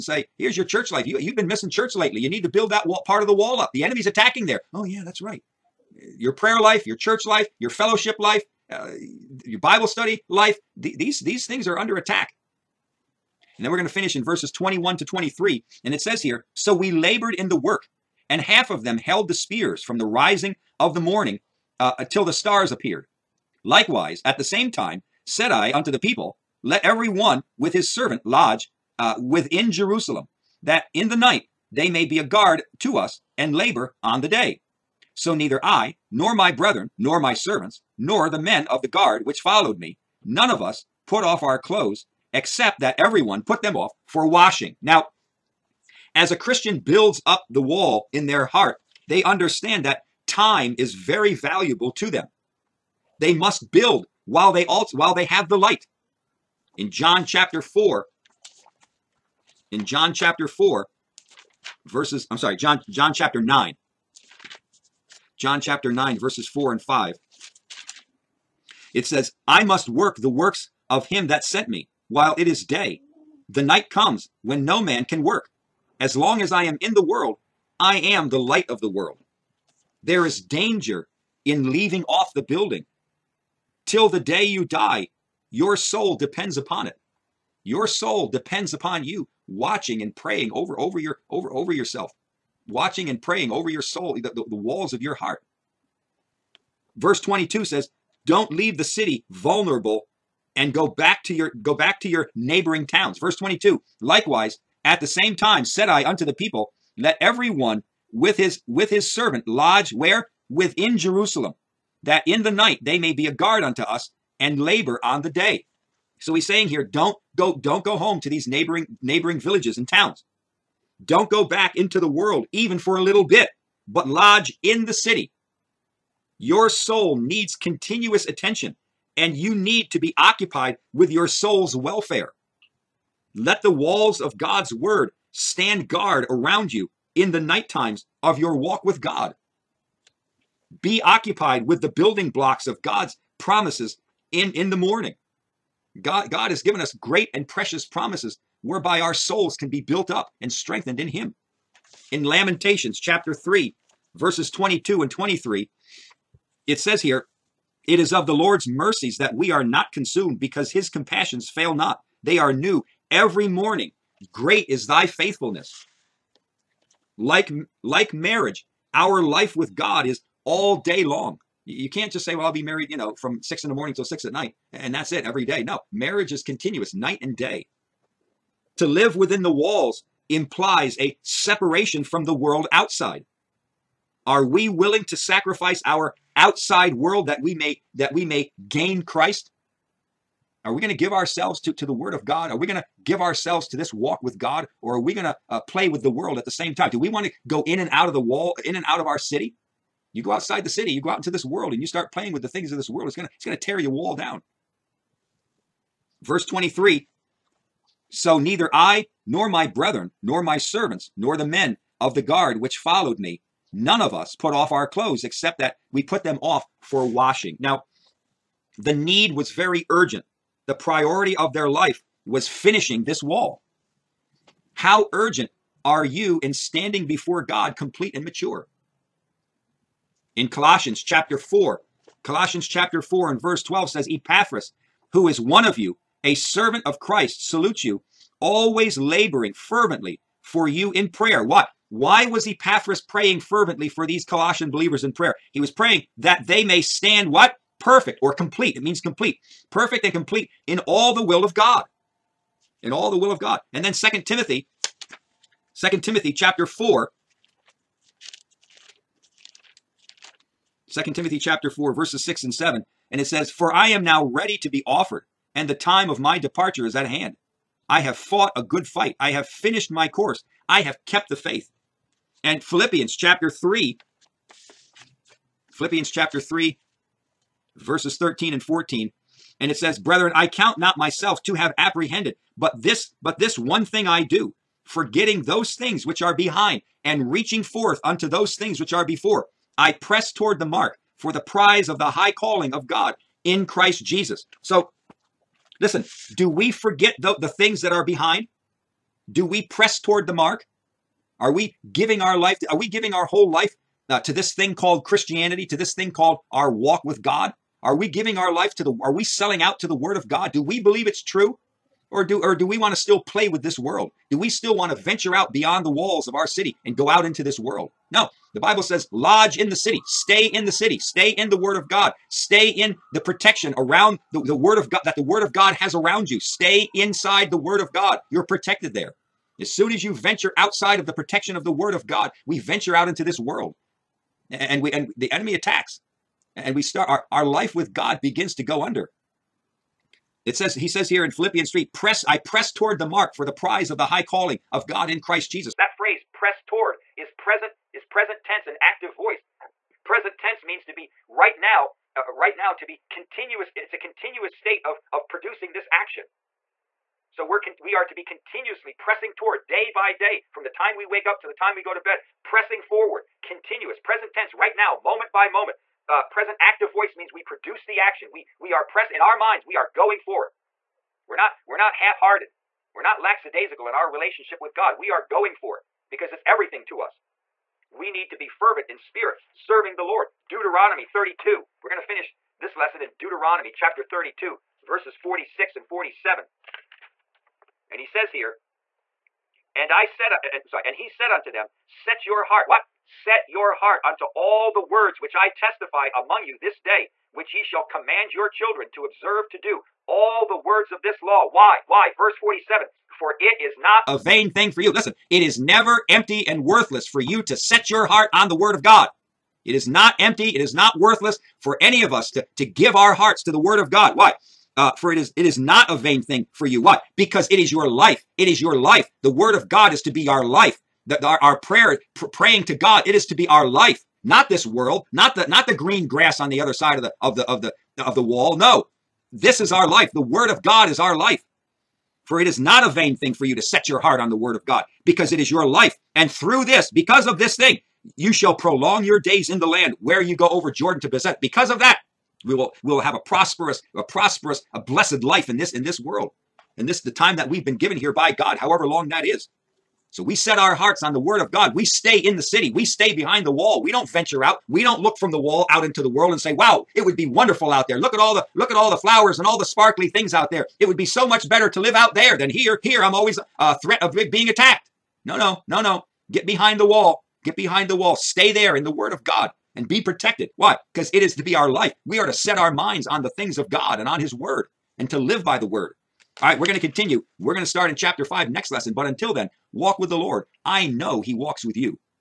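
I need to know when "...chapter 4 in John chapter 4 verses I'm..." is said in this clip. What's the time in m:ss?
0:57.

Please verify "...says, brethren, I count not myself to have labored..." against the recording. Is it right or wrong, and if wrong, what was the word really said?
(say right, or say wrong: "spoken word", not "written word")
wrong: "apprehended", not "labored".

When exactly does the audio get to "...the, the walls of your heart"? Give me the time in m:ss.
1:34.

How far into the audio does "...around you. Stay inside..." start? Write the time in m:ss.
5:25.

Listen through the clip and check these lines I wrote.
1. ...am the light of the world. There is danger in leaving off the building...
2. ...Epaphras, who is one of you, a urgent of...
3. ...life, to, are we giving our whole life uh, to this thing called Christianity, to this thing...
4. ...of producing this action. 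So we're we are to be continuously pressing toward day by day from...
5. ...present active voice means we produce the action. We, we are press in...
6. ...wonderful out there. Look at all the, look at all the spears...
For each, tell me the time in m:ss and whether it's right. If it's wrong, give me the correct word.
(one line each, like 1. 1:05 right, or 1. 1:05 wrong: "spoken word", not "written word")
1. 1:17 right
2. 3:54 wrong: "servant", not "urgent"
3. 5:02 right
4. 5:55 right
5. 6:06 right
6. 7:37 wrong: "flowers", not "spears".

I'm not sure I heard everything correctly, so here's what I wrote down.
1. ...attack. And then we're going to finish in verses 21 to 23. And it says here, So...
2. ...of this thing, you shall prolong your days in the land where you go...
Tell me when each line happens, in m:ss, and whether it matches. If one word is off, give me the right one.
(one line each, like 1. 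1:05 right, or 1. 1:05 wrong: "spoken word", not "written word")
1. 0:11 right
2. 7:17 right.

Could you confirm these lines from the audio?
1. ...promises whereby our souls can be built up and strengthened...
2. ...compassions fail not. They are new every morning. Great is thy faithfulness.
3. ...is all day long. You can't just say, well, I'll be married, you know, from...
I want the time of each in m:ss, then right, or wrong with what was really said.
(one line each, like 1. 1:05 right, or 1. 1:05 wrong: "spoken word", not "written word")
1. 2:27 right
2. 2:40 right
3. 2:50 right.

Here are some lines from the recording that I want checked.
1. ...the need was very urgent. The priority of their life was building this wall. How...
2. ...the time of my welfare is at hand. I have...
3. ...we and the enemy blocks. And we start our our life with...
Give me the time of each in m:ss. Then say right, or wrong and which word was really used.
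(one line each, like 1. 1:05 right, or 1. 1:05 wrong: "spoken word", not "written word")
1. 3:38 wrong: "finishing", not "building"
2. 4:25 wrong: "departure", not "welfare"
3. 5:34 wrong: "attacks", not "blocks".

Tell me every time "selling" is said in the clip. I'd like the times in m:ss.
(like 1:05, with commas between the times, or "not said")
5:09.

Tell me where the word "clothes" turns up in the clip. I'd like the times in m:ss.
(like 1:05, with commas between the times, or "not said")
0:41, 3:34.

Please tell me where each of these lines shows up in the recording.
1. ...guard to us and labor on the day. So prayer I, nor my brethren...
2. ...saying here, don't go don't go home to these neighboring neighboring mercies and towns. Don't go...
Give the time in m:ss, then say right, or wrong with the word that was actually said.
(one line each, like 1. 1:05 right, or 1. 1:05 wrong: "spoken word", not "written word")
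1. 0:32 wrong: "neither", not "prayer"
2. 1:56 wrong: "villages", not "mercies".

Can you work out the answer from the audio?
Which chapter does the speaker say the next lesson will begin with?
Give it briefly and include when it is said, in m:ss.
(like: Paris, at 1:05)
Chapter 5, at 7:57.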